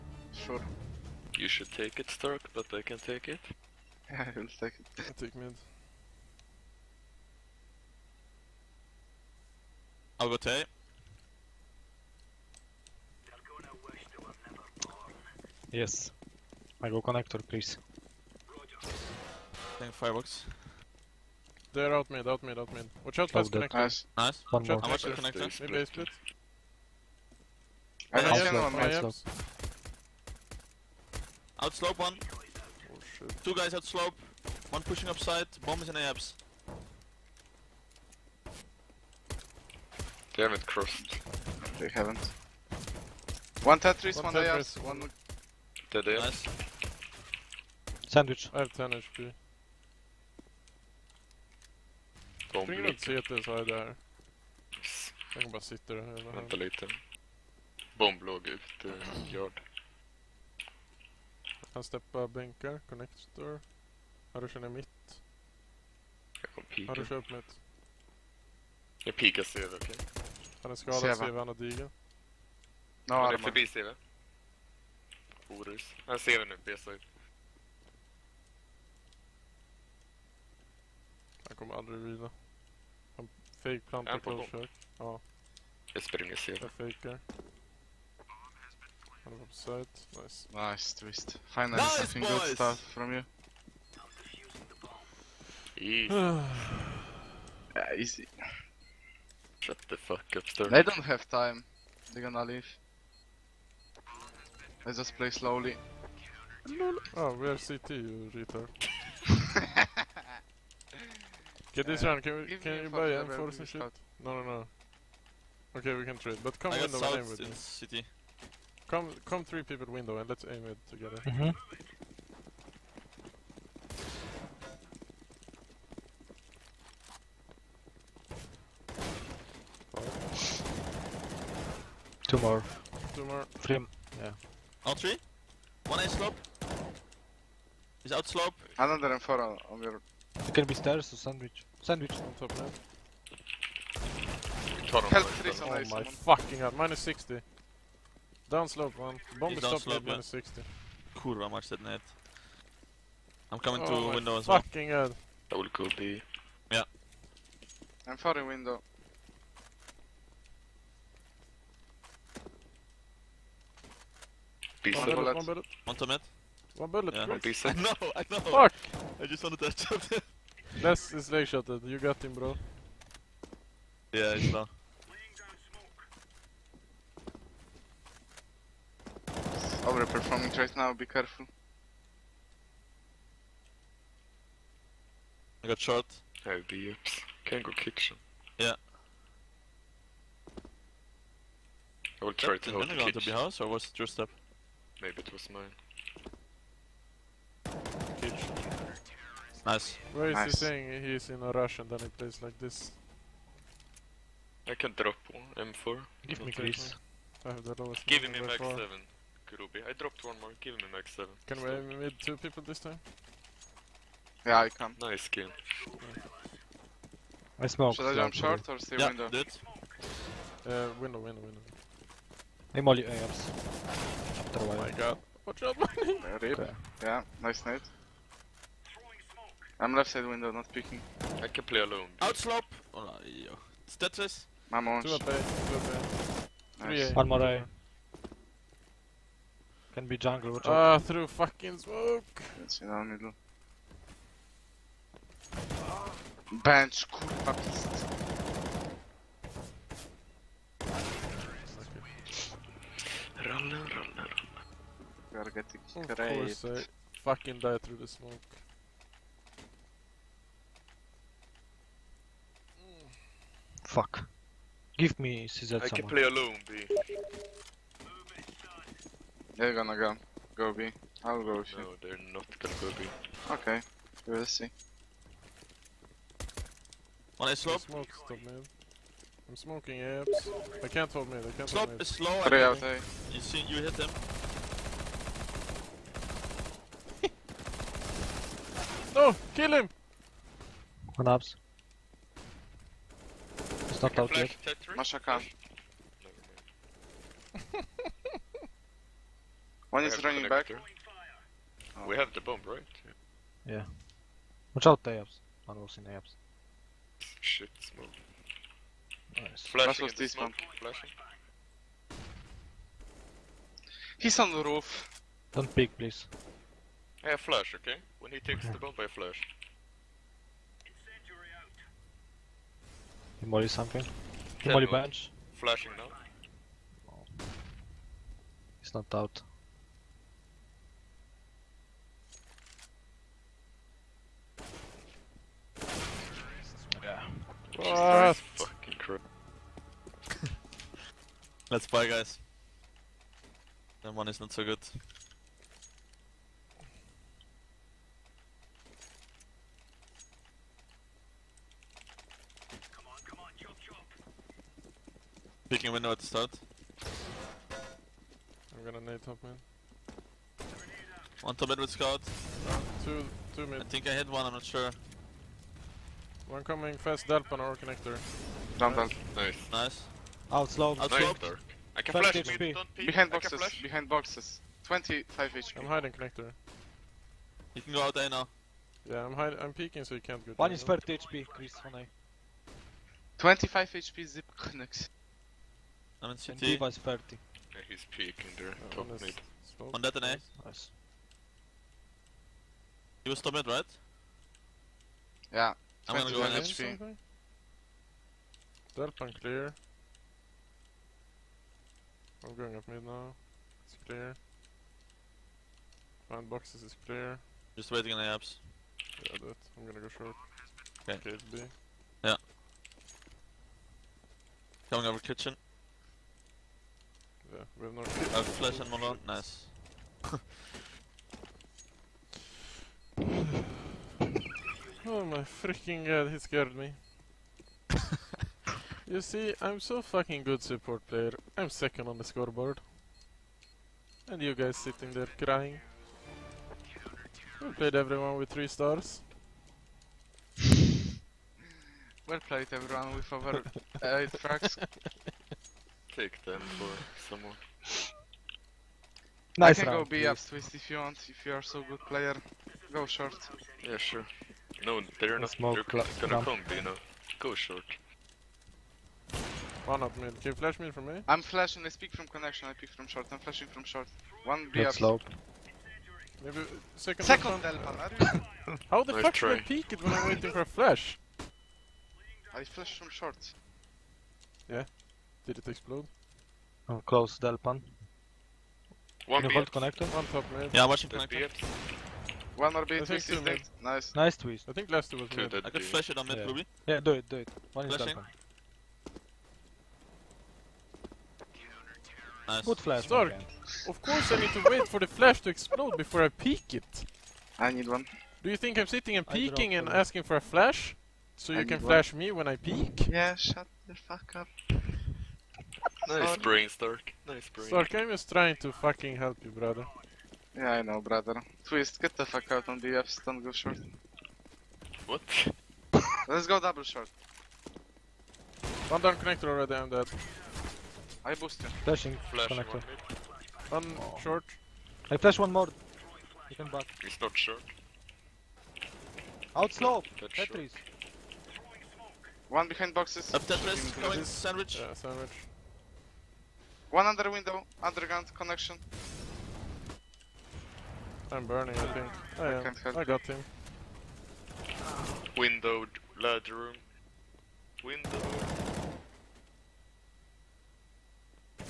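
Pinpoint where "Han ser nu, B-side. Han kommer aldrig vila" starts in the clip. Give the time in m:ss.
1:16.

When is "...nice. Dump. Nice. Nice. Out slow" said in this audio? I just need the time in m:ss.
6:08.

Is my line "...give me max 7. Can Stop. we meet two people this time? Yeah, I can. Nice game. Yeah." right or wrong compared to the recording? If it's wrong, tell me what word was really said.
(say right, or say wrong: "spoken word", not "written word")
right.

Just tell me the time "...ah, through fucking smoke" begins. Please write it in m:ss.
4:00.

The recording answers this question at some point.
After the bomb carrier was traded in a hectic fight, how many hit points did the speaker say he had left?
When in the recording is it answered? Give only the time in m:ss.
0:48.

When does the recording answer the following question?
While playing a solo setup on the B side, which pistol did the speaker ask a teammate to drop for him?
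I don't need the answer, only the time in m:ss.
4:24.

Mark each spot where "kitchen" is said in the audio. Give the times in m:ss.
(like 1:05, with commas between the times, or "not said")
3:07, 3:12, 6:55.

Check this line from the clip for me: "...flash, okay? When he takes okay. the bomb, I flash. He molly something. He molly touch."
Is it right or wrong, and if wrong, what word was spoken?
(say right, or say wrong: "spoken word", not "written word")
wrong: "bench", not "touch".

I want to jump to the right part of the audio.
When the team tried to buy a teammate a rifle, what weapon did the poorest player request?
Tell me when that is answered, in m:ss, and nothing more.
3:24.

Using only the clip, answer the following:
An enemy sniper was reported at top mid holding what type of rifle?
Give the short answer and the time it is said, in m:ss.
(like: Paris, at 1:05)
Scout, at 6:01.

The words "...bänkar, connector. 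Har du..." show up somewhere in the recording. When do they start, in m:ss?
1:02.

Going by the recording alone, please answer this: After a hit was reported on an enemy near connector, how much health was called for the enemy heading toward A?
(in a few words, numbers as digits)
30 HP.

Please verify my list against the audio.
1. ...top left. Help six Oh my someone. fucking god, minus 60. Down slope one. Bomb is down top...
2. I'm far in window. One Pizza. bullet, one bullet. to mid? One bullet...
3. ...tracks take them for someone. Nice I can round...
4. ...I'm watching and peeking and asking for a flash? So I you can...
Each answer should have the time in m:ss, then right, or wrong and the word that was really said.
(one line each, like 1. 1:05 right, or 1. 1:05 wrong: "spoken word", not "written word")
1. 2:22 wrong: "three", not "six"
2. 2:38 right
3. 7:24 right
4. 8:18 wrong: "sitting", not "watching".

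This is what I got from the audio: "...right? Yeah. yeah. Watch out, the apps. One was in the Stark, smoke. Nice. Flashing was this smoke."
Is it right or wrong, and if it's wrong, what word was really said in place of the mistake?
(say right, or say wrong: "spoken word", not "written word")
wrong: "Shit", not "Stark".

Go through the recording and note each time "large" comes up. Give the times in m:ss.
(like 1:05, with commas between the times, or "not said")
9:06.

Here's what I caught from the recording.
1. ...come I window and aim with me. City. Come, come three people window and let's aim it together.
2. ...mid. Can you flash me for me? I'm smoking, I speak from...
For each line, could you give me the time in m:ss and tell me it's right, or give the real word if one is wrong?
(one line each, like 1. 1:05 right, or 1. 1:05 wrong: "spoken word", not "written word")
1. 1:56 right
2. 7:40 wrong: "flashing", not "smoking".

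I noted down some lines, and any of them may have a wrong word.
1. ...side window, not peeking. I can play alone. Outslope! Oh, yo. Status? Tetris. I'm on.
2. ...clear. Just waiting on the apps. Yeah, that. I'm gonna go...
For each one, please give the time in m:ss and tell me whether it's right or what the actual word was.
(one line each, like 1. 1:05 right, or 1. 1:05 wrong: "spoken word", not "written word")
1. 3:50 right
2. 6:47 right.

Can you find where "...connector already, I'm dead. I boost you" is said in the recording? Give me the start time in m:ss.
8:39.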